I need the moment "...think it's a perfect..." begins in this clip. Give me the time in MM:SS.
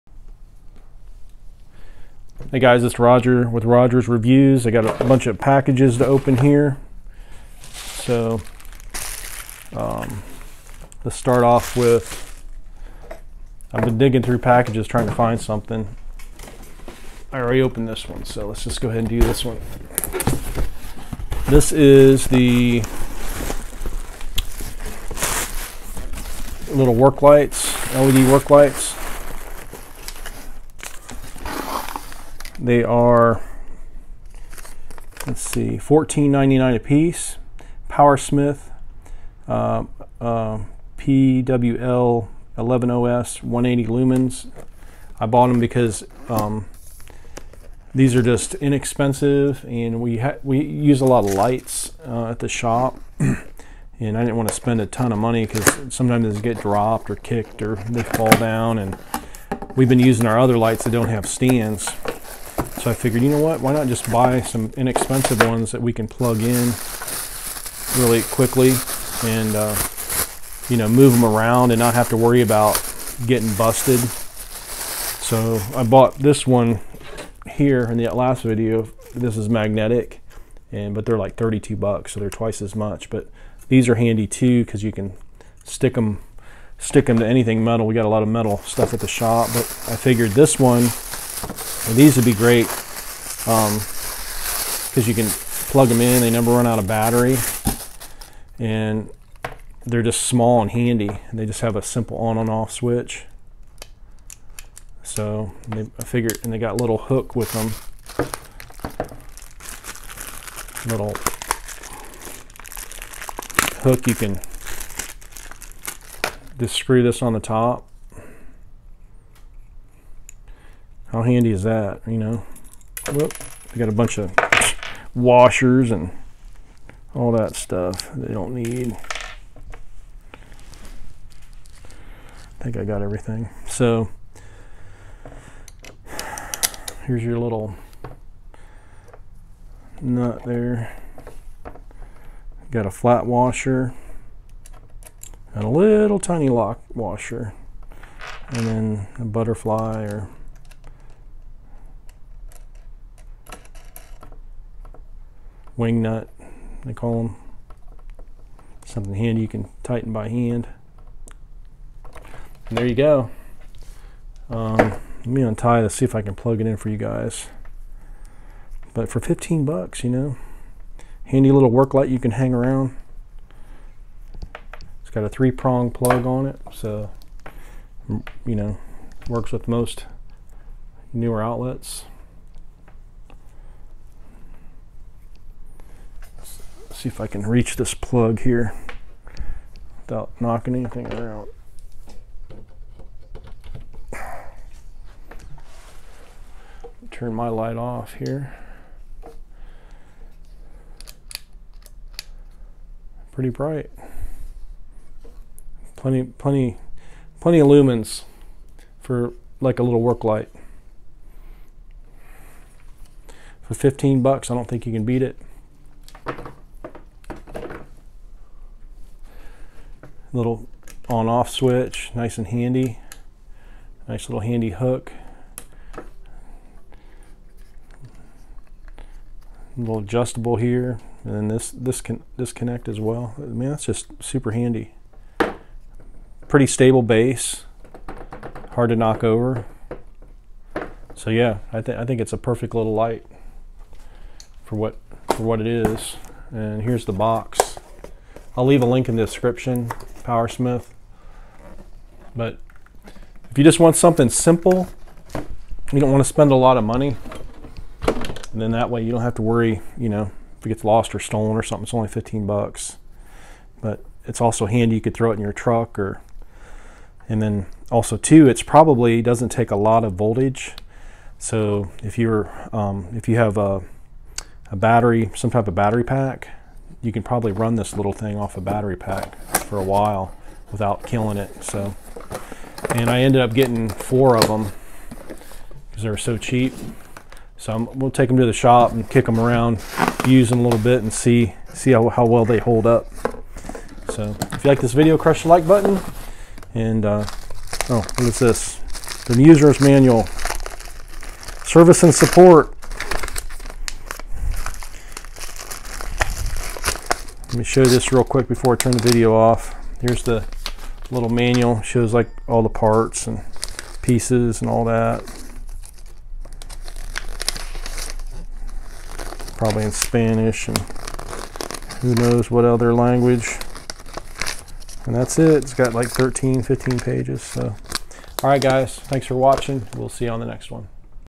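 04:02.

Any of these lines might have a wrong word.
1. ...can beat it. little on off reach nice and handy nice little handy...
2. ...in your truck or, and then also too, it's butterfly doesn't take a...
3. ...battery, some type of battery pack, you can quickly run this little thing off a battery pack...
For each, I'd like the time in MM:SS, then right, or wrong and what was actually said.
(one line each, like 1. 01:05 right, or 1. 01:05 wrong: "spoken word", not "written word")
1. 03:34 wrong: "switch", not "reach"
2. 04:25 wrong: "probably", not "butterfly"
3. 04:34 wrong: "probably", not "quickly".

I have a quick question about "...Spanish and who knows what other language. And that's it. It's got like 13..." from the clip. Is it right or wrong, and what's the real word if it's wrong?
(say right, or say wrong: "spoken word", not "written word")
right.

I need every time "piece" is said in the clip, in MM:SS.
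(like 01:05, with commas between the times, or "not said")
00:36, 05:14.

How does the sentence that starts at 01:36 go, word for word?
They never run out of battery.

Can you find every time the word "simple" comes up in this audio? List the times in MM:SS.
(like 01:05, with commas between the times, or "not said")
01:41, 04:14.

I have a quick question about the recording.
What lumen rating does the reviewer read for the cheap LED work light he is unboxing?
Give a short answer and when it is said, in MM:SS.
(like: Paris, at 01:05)
180, at 00:43.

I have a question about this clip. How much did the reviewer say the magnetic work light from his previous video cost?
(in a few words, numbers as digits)
$32.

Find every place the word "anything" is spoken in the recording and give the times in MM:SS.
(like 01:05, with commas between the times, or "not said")
01:27, 03:10.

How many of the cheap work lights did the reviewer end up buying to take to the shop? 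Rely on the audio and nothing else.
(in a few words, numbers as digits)
4.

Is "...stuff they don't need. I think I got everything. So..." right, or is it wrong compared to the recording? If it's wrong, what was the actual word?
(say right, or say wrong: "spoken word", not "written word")
right.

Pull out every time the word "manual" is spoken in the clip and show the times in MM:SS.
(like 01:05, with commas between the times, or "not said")
04:59, 05:11.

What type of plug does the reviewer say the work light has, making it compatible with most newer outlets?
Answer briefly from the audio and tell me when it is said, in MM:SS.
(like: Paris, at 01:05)
three prong plug, at 02:55.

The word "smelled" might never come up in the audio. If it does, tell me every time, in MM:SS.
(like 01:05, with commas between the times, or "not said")
not said.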